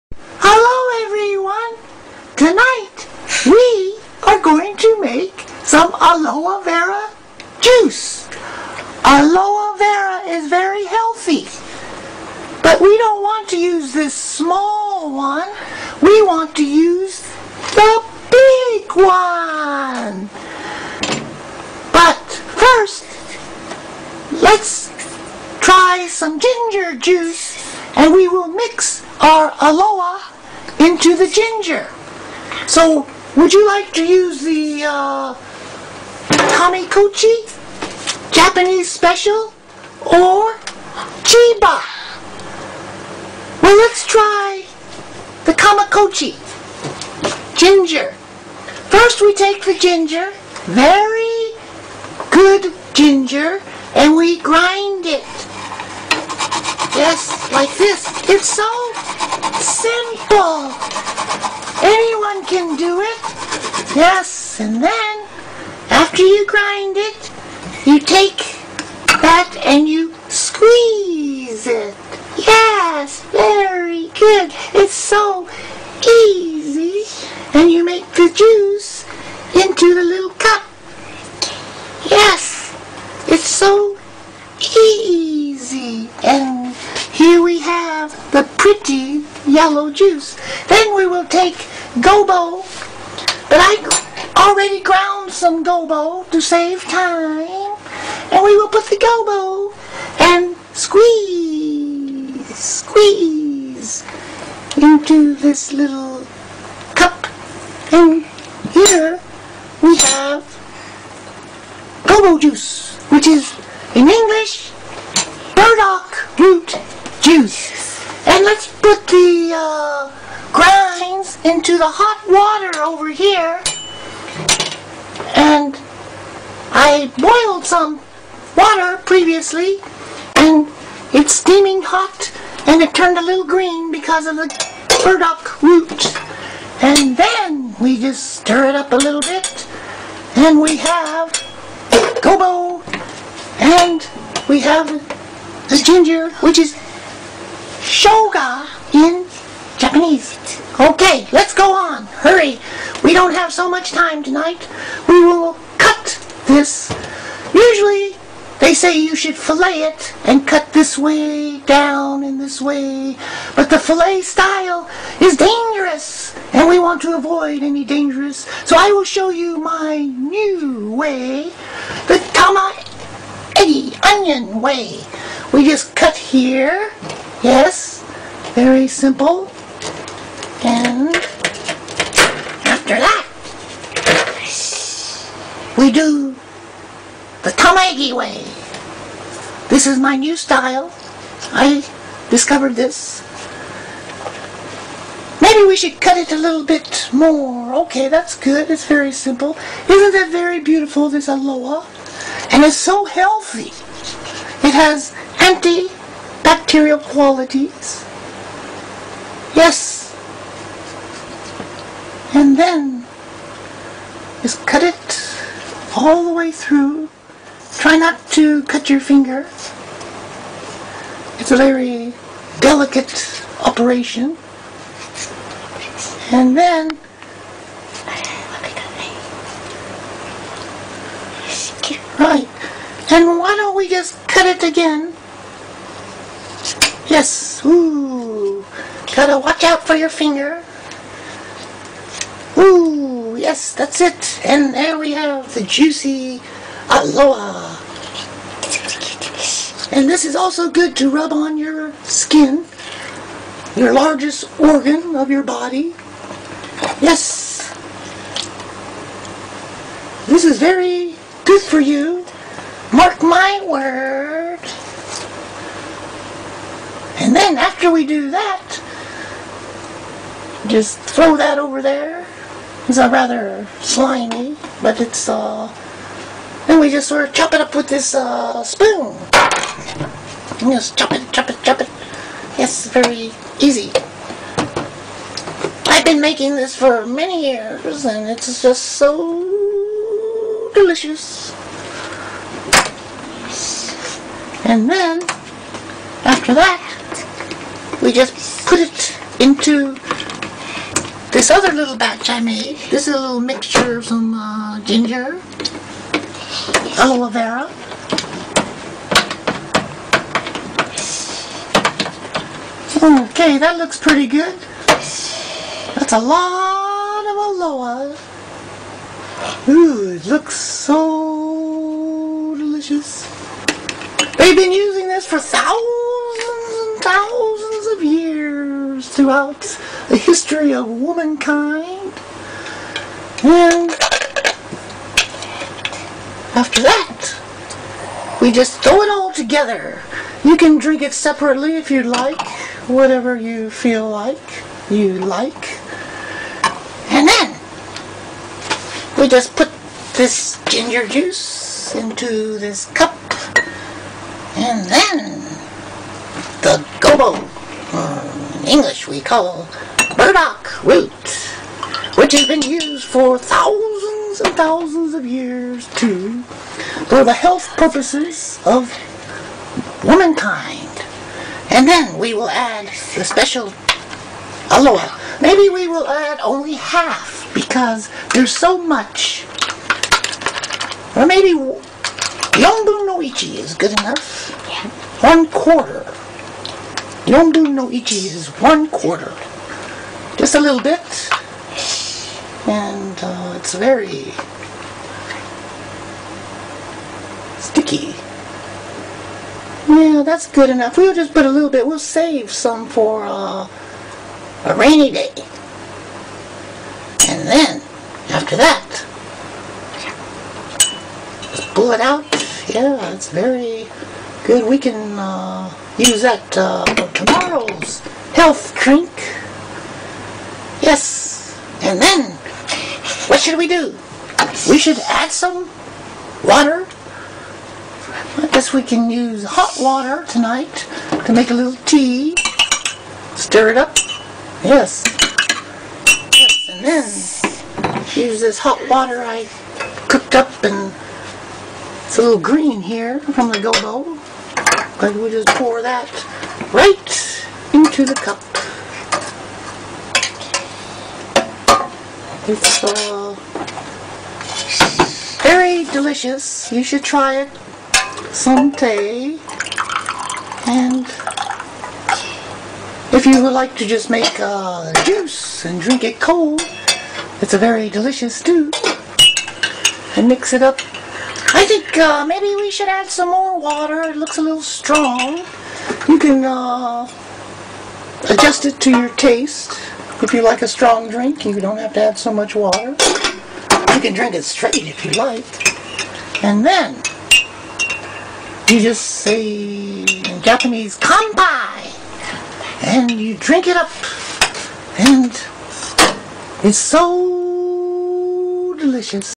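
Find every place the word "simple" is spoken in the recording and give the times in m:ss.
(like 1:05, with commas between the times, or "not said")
0:59, 2:58, 3:19.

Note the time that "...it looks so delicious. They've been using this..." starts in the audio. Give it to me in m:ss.
5:20.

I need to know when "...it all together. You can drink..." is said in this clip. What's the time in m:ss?
5:39.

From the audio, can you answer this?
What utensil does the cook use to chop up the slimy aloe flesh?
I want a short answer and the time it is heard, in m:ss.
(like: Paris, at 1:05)
spoon, at 4:38.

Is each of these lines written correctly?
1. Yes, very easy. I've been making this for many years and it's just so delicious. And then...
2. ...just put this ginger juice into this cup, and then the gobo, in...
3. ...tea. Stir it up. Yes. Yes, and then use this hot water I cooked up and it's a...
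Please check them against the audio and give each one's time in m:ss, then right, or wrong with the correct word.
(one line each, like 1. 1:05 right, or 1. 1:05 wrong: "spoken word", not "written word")
1. 4:42 right
2. 5:49 right
3. 7:11 right.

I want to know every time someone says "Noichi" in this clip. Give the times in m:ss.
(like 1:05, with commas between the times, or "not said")
6:22, 6:27.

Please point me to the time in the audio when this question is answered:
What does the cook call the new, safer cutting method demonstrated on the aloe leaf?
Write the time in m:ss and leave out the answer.
2:52.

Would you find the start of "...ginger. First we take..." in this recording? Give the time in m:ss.
0:47.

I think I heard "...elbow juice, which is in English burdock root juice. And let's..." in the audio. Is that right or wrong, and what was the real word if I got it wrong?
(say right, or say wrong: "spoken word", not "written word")
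right.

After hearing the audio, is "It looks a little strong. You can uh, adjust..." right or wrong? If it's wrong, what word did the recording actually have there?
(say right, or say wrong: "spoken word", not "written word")
right.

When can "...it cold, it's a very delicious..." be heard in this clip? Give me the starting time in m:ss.
7:46.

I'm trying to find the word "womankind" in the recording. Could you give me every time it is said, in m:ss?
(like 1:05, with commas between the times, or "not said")
5:30, 6:10.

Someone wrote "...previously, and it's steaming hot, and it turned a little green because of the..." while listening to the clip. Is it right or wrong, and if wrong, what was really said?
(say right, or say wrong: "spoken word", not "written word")
right.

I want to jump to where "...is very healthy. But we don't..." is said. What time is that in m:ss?
0:10.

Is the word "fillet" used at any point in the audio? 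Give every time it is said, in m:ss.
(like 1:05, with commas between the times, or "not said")
2:39, 2:43.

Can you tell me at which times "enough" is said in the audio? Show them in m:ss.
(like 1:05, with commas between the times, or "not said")
6:23, 6:40.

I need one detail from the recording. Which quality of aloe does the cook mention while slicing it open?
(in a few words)
antibacterial.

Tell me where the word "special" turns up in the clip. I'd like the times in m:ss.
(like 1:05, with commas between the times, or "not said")
0:38, 6:13.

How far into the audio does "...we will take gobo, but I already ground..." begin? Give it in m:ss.
1:30.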